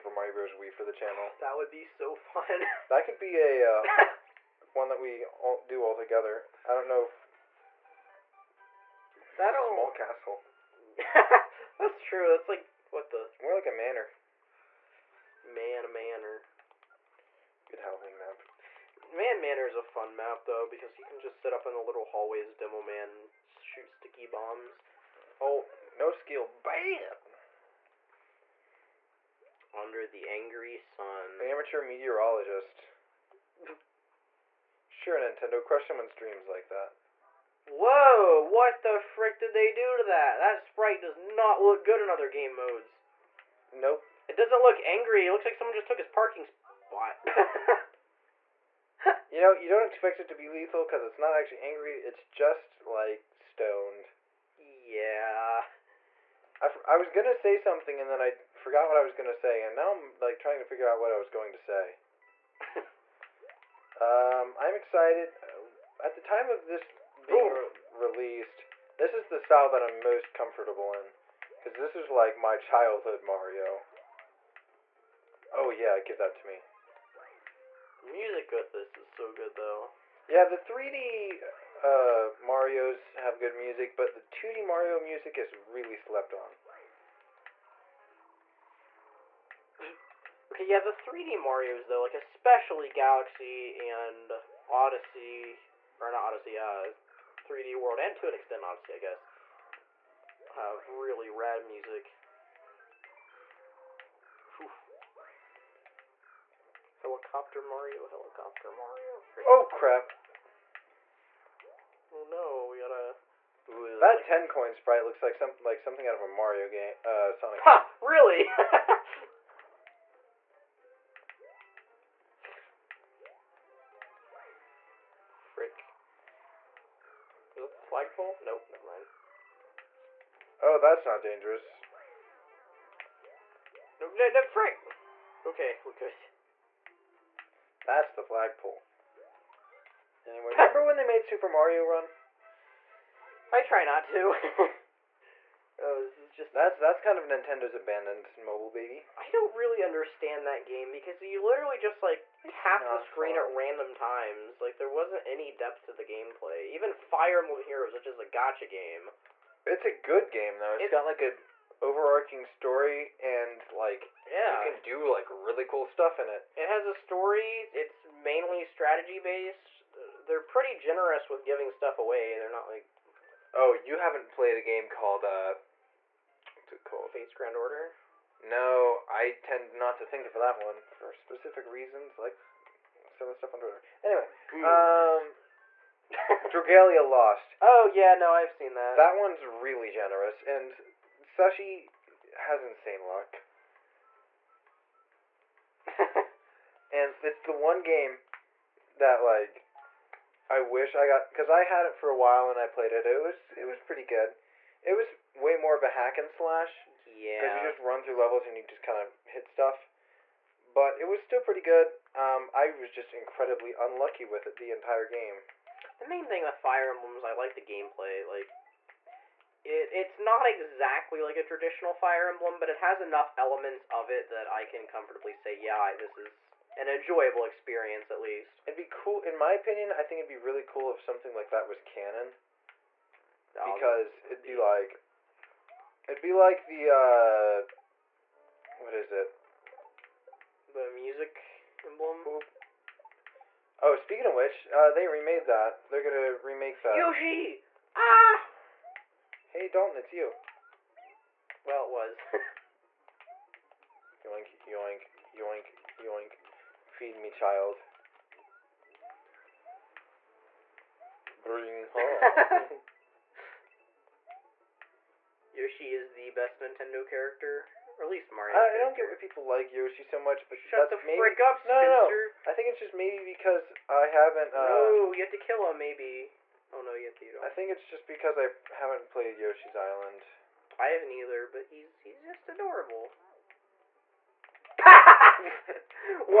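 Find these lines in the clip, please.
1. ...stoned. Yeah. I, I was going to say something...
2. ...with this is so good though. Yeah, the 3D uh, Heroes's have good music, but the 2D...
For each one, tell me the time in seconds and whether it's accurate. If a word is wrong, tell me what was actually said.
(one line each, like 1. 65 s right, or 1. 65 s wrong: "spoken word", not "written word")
1. 53 s right
2. 78 s wrong: "Mario", not "Heroes".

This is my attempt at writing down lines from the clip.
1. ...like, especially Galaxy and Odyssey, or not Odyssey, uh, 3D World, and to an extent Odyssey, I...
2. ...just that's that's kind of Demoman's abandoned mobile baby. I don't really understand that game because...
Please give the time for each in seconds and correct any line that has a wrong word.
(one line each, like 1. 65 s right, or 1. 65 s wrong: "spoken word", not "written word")
1. 91 s right
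2. 146 s wrong: "Nintendo", not "Demoman".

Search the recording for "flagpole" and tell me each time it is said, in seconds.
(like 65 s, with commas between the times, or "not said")
127 s, 138 s.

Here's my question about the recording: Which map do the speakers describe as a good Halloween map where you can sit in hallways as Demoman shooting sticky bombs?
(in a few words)
Mann Manor.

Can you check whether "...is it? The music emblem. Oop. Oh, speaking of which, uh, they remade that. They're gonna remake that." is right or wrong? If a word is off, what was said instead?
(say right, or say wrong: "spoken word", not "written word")
right.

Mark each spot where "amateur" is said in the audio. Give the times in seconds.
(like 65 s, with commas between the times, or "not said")
31 s.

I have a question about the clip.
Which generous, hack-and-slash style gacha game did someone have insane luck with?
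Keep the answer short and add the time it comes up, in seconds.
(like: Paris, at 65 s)
Dragalia Lost, at 186 s.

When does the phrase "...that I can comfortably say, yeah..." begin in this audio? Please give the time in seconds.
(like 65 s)
224 s.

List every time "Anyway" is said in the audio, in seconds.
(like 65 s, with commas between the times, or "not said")
140 s, 184 s.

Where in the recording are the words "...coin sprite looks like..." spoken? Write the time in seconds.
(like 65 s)
114 s.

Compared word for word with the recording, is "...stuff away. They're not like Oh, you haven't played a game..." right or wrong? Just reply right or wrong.
right.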